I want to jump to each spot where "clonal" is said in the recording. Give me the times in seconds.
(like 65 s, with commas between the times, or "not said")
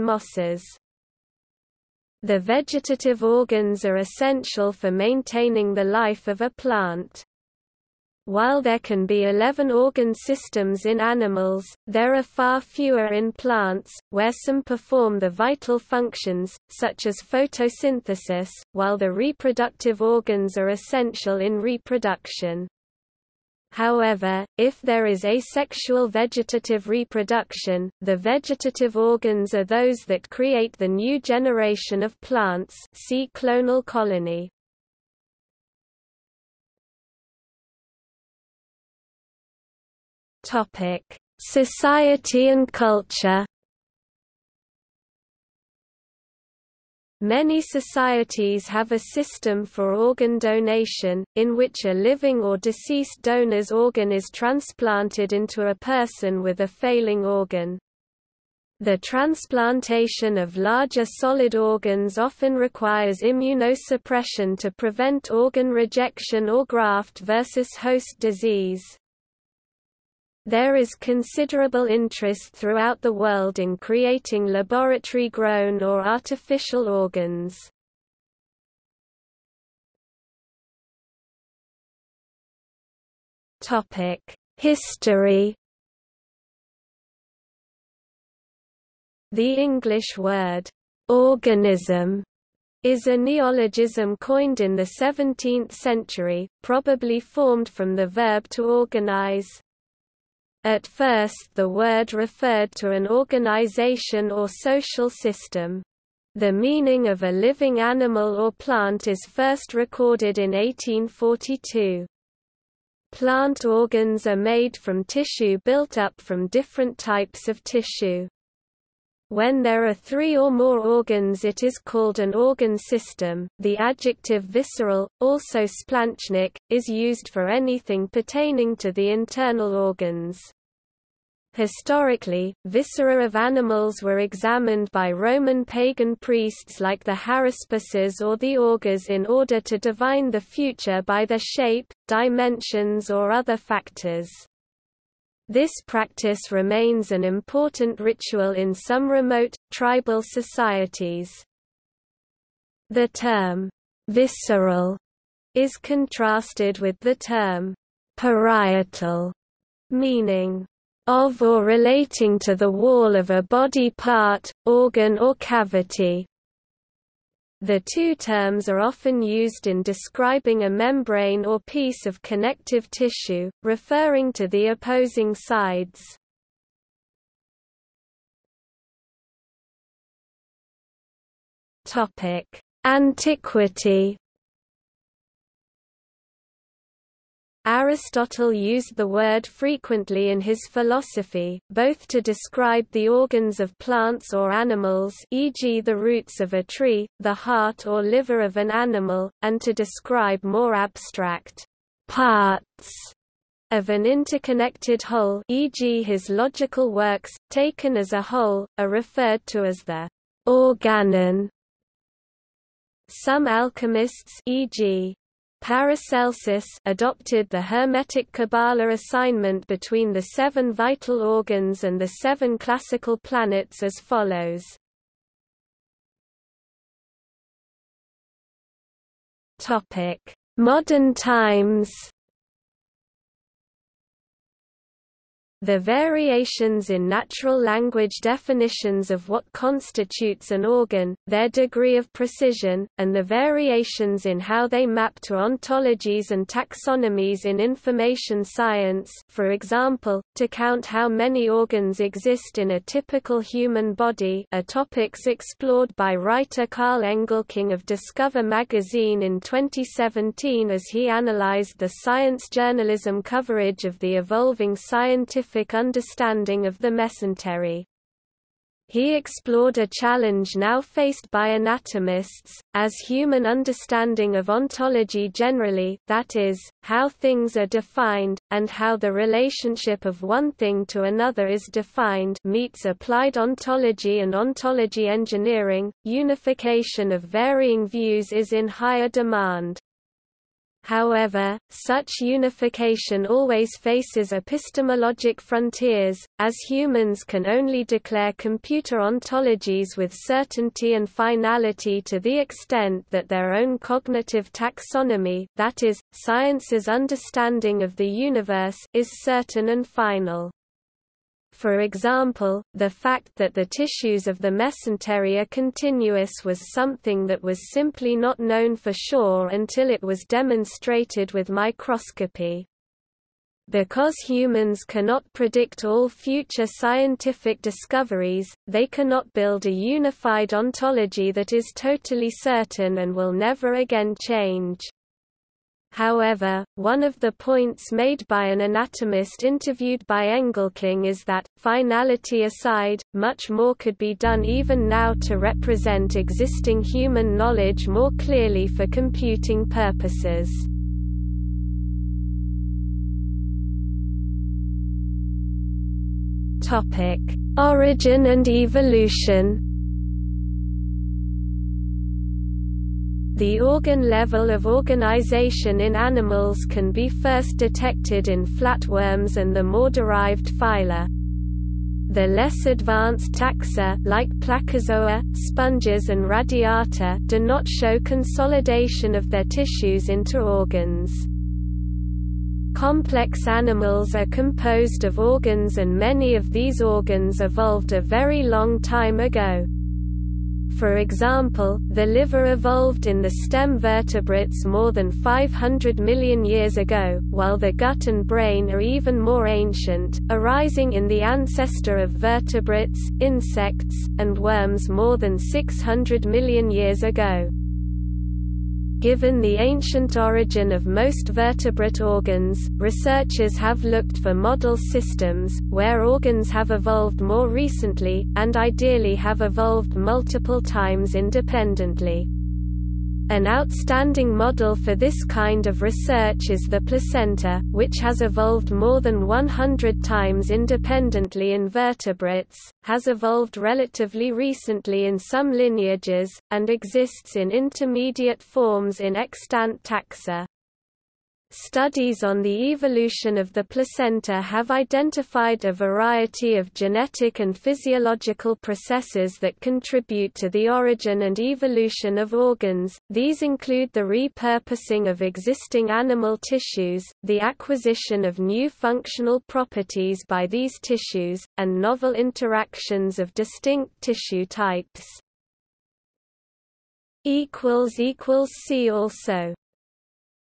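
33 s.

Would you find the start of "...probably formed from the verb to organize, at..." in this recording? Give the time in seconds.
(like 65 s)
96 s.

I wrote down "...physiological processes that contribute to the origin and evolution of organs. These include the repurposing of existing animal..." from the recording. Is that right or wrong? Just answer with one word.
right.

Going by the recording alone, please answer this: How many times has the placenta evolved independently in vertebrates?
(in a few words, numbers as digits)
more than 100.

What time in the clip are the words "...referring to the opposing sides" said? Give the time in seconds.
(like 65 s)
173 s.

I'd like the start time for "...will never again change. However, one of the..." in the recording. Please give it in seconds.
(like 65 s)
333 s.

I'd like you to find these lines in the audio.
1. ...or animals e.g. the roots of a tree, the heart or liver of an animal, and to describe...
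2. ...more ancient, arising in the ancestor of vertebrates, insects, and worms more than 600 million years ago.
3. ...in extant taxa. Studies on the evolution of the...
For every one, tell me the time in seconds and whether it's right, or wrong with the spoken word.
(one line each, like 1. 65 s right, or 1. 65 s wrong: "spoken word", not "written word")
1. 194 s right
2. 399 s right
3. 438 s right.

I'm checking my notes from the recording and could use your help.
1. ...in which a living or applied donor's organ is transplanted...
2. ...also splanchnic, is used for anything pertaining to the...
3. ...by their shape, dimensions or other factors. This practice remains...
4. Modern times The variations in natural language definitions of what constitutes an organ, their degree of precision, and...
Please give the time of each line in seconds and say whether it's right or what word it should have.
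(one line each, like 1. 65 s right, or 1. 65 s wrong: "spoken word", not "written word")
1. 51 s wrong: "deceased", not "applied"
2. 125 s right
3. 141 s right
4. 230 s right.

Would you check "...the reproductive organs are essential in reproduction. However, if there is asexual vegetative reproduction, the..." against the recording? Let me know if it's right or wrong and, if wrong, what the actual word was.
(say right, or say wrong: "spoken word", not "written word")
right.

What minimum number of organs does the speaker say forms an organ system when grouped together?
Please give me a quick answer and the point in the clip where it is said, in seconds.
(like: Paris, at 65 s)
3, at 119 s.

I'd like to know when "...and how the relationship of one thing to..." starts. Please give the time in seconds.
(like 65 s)
278 s.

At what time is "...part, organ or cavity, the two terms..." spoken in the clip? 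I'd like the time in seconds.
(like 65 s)
163 s.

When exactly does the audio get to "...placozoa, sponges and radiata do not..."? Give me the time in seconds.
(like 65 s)
374 s.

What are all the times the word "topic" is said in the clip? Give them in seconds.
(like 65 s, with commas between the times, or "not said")
40 s, 254 s.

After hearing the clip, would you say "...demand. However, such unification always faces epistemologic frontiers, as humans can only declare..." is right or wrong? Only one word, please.
right.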